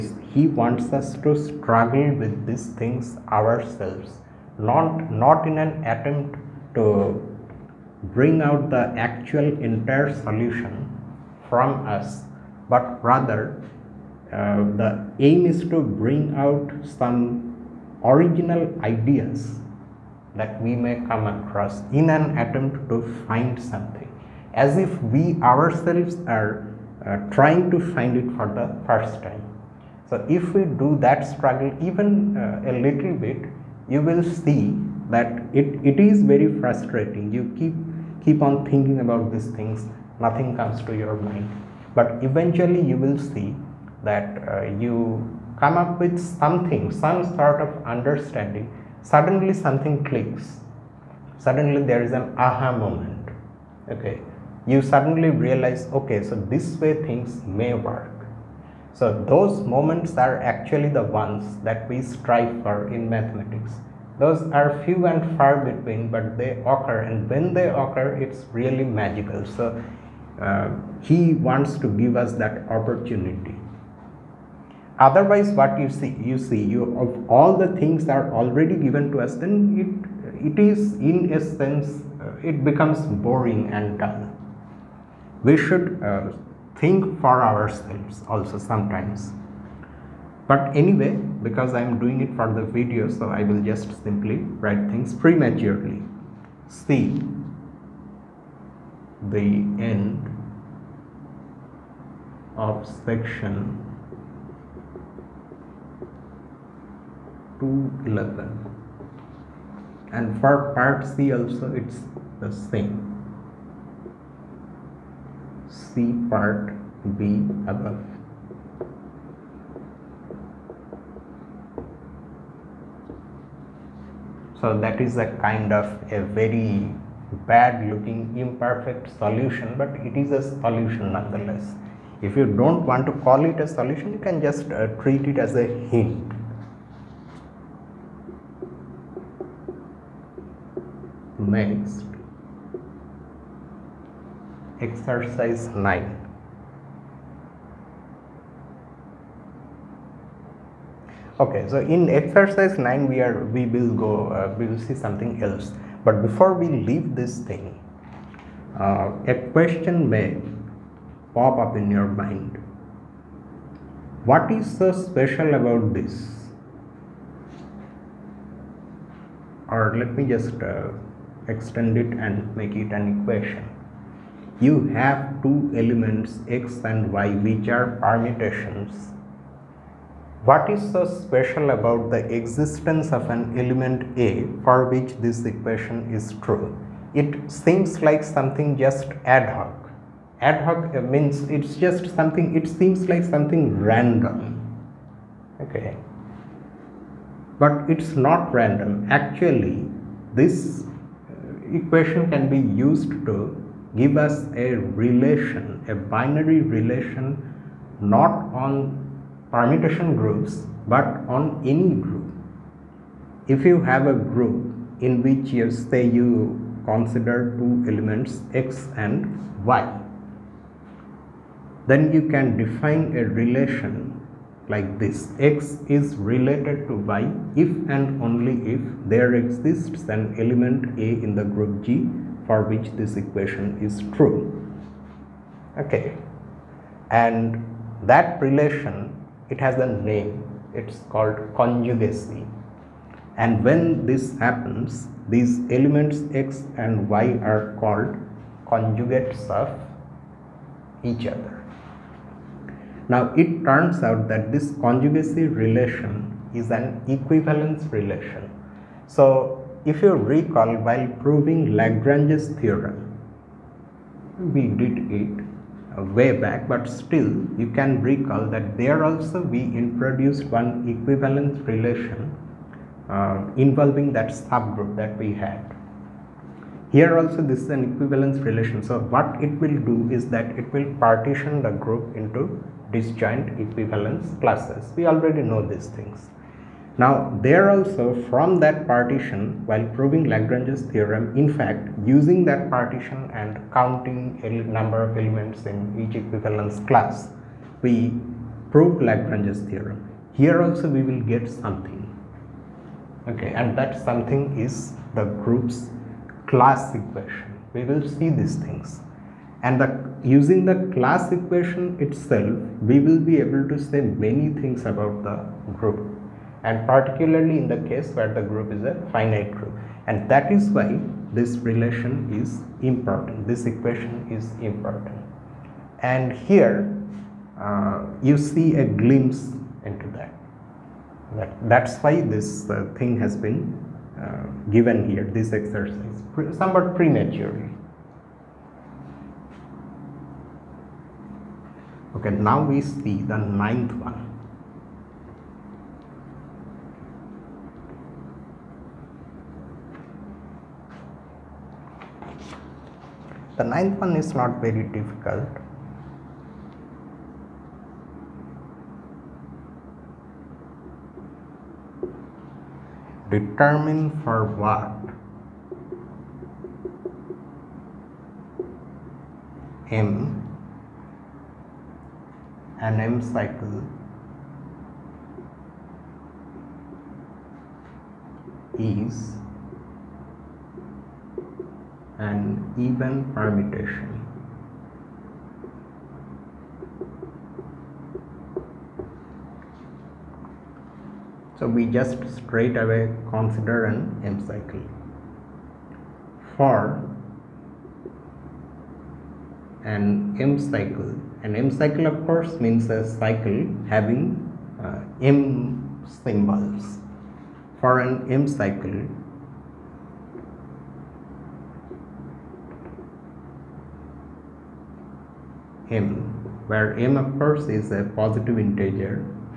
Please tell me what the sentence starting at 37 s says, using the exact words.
You keep keep on thinking about these things, nothing comes to your mind.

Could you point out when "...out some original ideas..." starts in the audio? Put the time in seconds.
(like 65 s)
16 s.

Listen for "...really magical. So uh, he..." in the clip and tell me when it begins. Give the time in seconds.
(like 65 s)
68 s.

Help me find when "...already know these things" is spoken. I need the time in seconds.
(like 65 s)
285 s.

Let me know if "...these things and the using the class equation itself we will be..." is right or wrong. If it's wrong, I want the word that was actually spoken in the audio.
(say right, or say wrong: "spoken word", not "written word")
right.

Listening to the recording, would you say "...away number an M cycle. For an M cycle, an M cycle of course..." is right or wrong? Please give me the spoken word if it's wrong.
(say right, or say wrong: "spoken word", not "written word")
wrong: "consider", not "number".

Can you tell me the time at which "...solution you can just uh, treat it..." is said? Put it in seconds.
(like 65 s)
133 s.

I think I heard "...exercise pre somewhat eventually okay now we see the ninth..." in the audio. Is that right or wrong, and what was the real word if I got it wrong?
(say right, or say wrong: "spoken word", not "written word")
wrong: "prematurely", not "eventually".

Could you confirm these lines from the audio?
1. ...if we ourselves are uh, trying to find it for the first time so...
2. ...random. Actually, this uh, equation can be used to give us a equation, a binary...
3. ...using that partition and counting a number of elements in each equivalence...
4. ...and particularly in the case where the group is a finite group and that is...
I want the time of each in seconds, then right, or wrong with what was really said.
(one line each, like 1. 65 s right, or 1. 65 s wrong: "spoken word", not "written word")
1. 24 s right
2. 198 s wrong: "relation", not "equation"
3. 292 s right
4. 316 s right.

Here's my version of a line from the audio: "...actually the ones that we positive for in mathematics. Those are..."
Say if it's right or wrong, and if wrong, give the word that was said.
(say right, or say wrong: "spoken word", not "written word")
wrong: "strive", not "positive".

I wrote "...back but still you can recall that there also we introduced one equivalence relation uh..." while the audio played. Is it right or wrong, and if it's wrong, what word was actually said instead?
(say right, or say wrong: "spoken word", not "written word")
right.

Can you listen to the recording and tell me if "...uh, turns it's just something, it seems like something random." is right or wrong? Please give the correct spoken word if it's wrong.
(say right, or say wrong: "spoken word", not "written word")
wrong: "means", not "turns".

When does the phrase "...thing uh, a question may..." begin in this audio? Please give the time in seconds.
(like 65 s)
157 s.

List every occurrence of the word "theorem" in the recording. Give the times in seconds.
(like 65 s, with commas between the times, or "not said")
262 s, 290 s, 299 s.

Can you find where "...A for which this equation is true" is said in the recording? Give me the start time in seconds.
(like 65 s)
184 s.